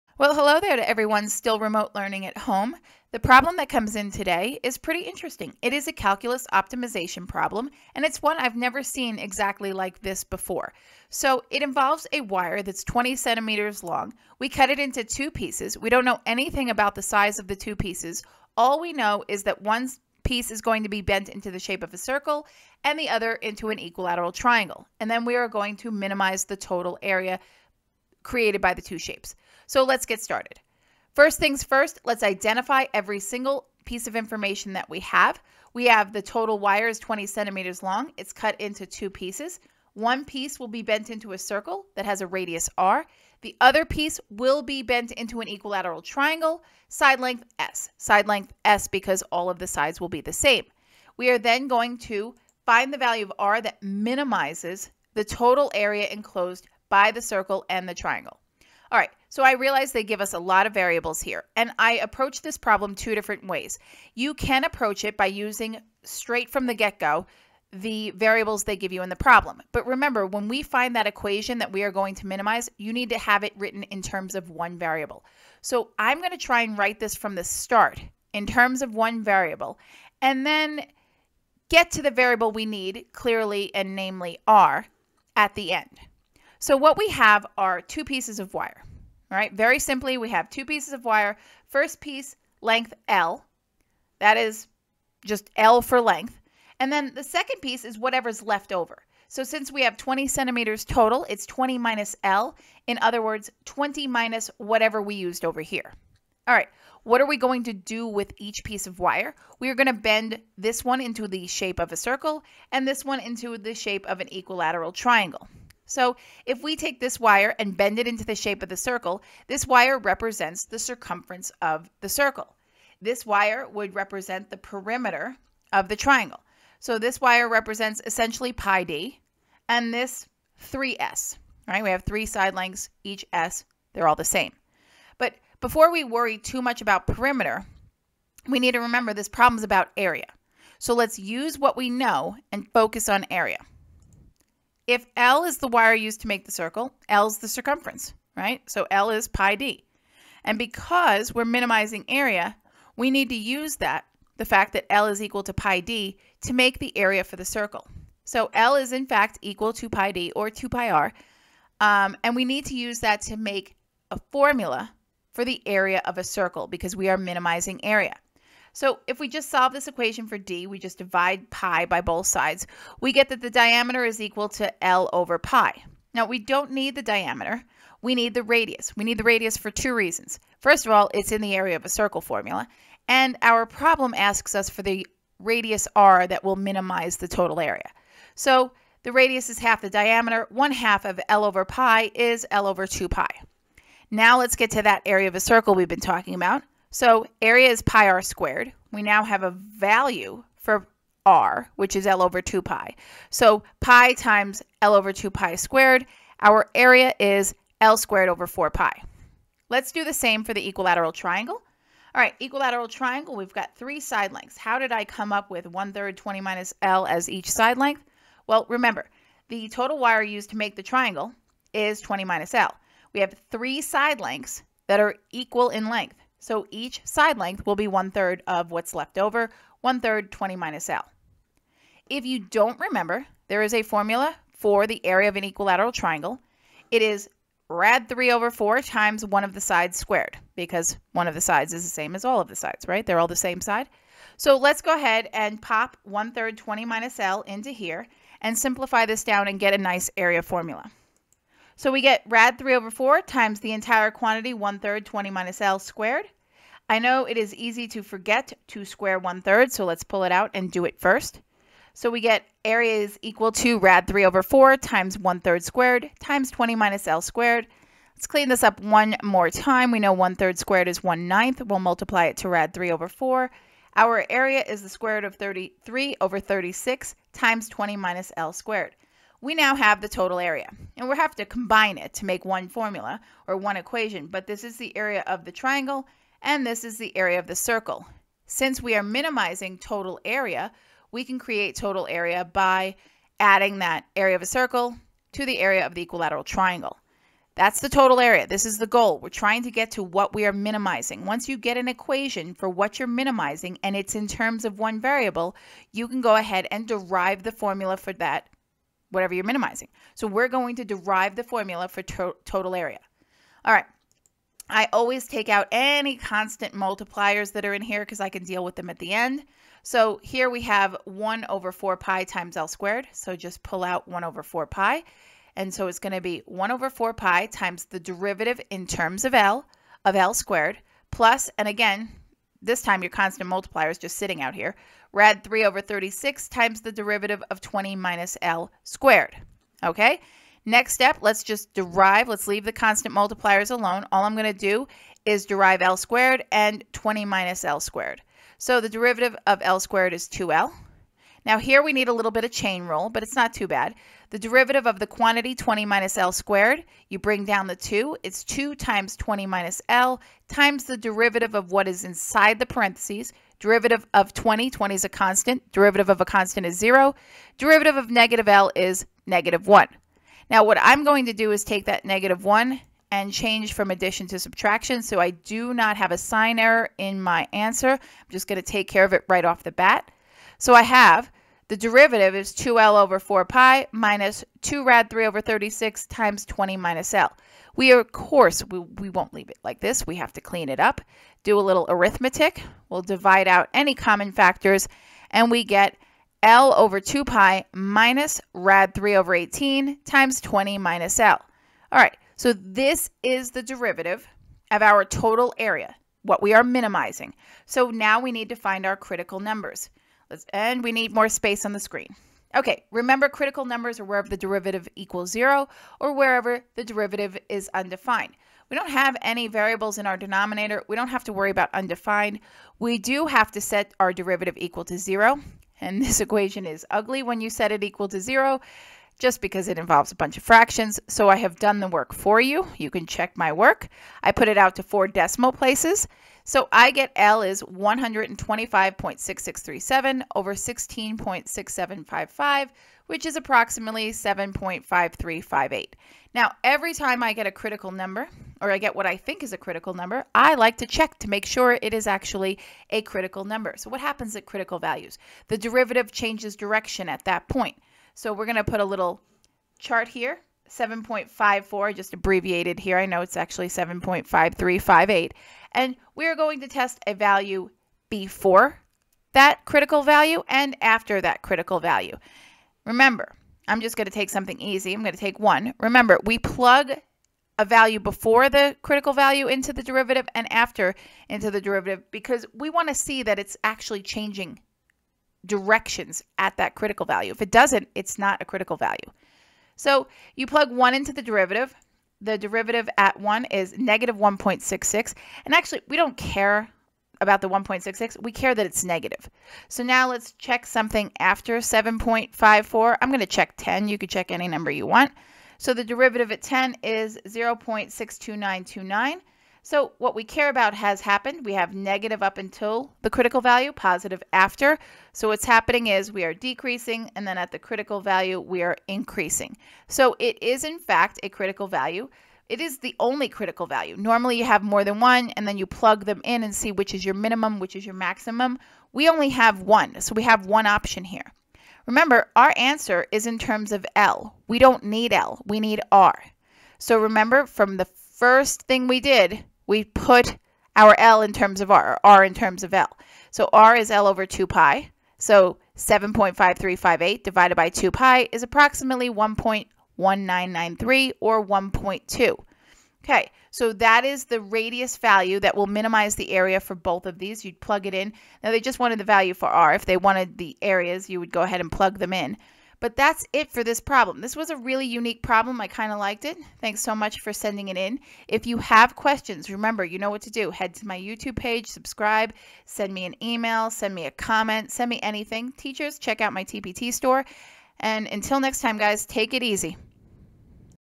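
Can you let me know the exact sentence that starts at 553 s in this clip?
Okay, so that is the radius value that will minimize the area for both of these.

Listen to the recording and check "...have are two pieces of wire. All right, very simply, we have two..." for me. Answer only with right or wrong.
right.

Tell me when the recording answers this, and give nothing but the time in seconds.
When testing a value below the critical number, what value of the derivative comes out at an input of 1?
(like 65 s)
493 s.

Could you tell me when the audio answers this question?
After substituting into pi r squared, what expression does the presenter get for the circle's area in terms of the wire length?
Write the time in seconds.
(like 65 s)
207 s.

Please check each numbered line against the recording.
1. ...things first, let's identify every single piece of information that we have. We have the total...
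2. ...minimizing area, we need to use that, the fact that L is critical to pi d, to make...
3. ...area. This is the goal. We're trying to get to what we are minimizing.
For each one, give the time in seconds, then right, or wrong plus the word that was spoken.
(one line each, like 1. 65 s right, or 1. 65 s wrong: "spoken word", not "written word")
1. 31 s right
2. 151 s wrong: "equal", not "critical"
3. 298 s right.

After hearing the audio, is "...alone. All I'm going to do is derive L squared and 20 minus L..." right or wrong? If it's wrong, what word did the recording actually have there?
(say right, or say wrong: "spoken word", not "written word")
right.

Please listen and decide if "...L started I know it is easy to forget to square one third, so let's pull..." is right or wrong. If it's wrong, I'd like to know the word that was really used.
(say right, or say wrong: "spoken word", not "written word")
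wrong: "squared", not "started".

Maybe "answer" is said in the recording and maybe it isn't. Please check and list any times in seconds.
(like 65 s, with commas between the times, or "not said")
377 s, 532 s.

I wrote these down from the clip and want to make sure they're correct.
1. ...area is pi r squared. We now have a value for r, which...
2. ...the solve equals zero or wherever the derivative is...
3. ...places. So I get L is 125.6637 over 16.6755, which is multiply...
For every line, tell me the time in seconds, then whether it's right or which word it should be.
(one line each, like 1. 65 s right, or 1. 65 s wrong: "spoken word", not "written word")
1. 197 s right
2. 414 s wrong: "derivative", not "solve"
3. 435 s wrong: "approximately", not "multiply".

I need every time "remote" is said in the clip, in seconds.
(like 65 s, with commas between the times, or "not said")
1 s.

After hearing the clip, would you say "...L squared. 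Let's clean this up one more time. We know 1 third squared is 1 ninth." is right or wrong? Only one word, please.
right.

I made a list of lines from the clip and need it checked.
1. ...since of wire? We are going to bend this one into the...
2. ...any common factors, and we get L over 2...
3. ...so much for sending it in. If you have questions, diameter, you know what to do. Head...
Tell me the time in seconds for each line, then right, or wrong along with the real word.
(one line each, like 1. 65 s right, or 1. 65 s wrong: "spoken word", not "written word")
1. 108 s wrong: "piece", not "since"
2. 393 s right
3. 566 s wrong: "remember", not "diameter".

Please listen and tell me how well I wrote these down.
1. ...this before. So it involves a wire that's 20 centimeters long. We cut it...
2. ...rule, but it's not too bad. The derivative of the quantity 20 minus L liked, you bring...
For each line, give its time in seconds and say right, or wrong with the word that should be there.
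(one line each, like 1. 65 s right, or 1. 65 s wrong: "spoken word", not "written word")
1. 10 s right
2. 352 s wrong: "squared", not "liked".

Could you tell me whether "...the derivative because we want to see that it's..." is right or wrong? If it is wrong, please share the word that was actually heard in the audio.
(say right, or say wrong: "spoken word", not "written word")
right.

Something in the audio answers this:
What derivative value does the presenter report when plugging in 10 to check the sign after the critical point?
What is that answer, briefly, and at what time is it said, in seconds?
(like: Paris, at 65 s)
0.62929, at 507 s.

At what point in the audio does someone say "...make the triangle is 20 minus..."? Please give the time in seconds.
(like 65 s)
220 s.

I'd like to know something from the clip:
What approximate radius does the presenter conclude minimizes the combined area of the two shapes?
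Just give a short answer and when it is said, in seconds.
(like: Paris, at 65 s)
1.1993, at 549 s.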